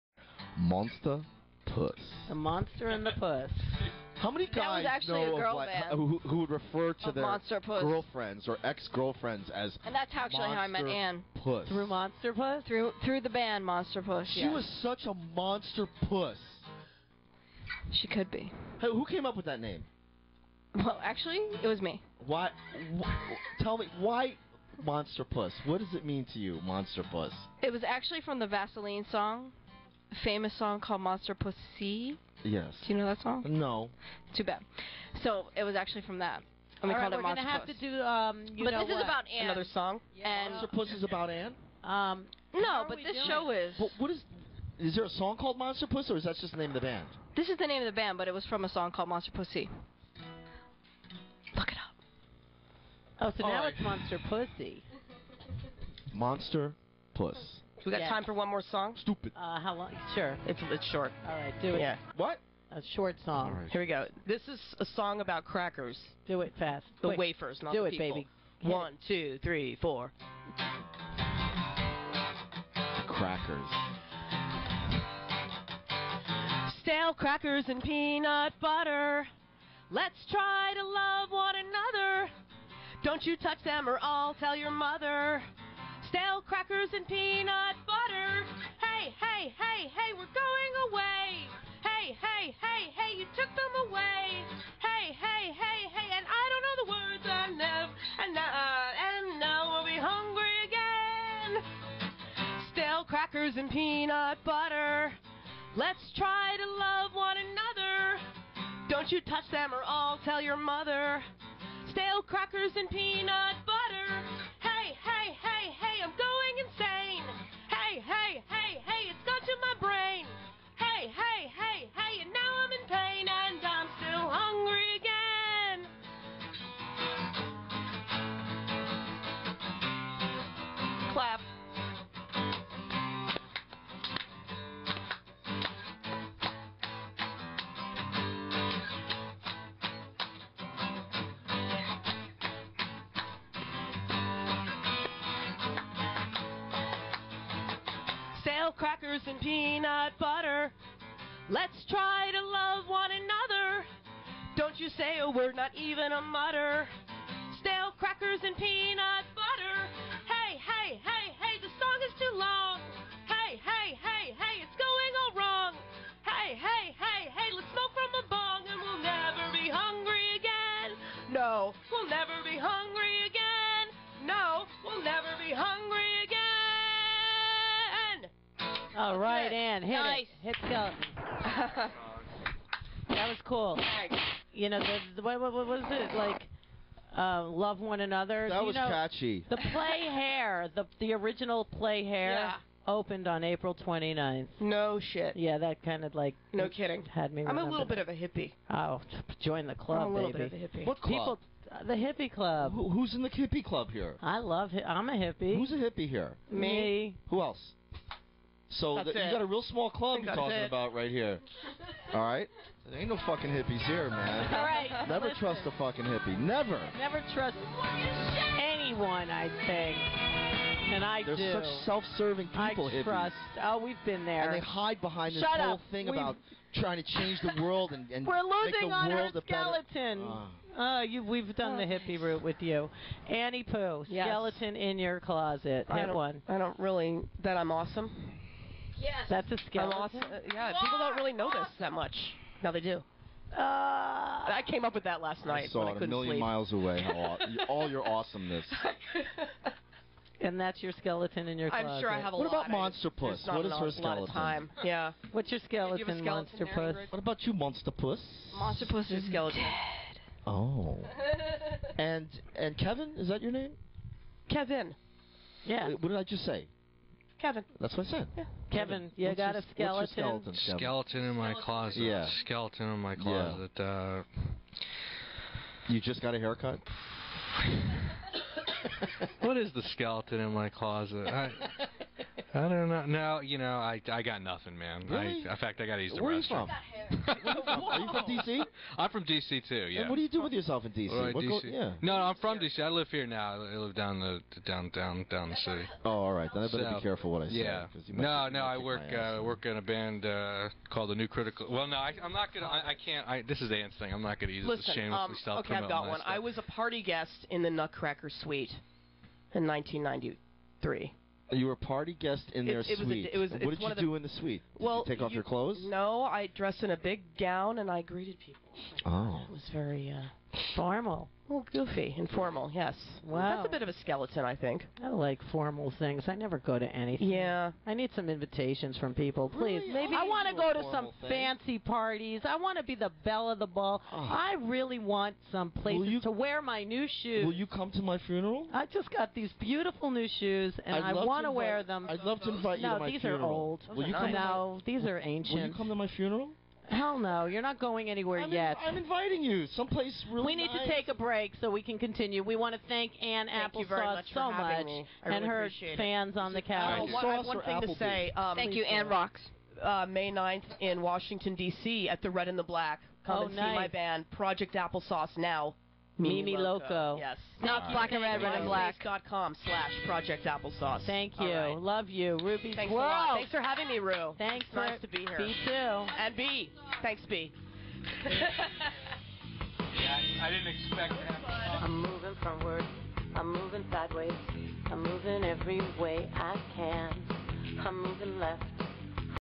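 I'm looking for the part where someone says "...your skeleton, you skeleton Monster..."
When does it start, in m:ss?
4:15.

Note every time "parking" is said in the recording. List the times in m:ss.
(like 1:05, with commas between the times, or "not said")
not said.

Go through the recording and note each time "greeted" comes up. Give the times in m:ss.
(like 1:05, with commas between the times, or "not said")
5:18.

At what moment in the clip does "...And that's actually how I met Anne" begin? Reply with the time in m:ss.
0:09.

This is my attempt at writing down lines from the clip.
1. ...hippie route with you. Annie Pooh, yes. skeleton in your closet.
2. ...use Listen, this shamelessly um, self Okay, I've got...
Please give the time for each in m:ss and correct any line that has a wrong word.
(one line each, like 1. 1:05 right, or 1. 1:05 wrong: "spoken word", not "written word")
1. 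3:51 right
2. 5:04 right.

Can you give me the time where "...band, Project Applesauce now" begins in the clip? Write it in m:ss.
6:03.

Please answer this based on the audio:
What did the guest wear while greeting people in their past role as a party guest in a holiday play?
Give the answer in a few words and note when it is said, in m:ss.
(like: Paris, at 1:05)
big gown, at 5:16.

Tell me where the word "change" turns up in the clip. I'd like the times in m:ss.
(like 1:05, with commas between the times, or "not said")
3:47.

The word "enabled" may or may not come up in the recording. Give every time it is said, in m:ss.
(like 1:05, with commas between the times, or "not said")
not said.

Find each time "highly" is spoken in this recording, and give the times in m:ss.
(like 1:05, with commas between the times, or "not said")
not said.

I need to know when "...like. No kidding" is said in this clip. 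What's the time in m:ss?
3:16.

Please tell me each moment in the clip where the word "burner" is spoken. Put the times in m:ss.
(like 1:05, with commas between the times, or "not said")
not said.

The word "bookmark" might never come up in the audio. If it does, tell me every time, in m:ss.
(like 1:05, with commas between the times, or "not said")
not said.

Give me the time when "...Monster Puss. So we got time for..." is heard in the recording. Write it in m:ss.
0:56.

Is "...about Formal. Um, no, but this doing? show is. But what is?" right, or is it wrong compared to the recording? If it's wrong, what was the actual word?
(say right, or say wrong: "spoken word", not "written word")
wrong: "Anne", not "Formal".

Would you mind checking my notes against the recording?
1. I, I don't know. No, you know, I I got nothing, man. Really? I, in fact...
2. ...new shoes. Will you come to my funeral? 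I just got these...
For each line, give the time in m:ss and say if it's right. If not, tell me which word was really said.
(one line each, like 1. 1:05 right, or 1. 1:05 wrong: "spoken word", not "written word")
1. 4:41 right
2. 5:36 right.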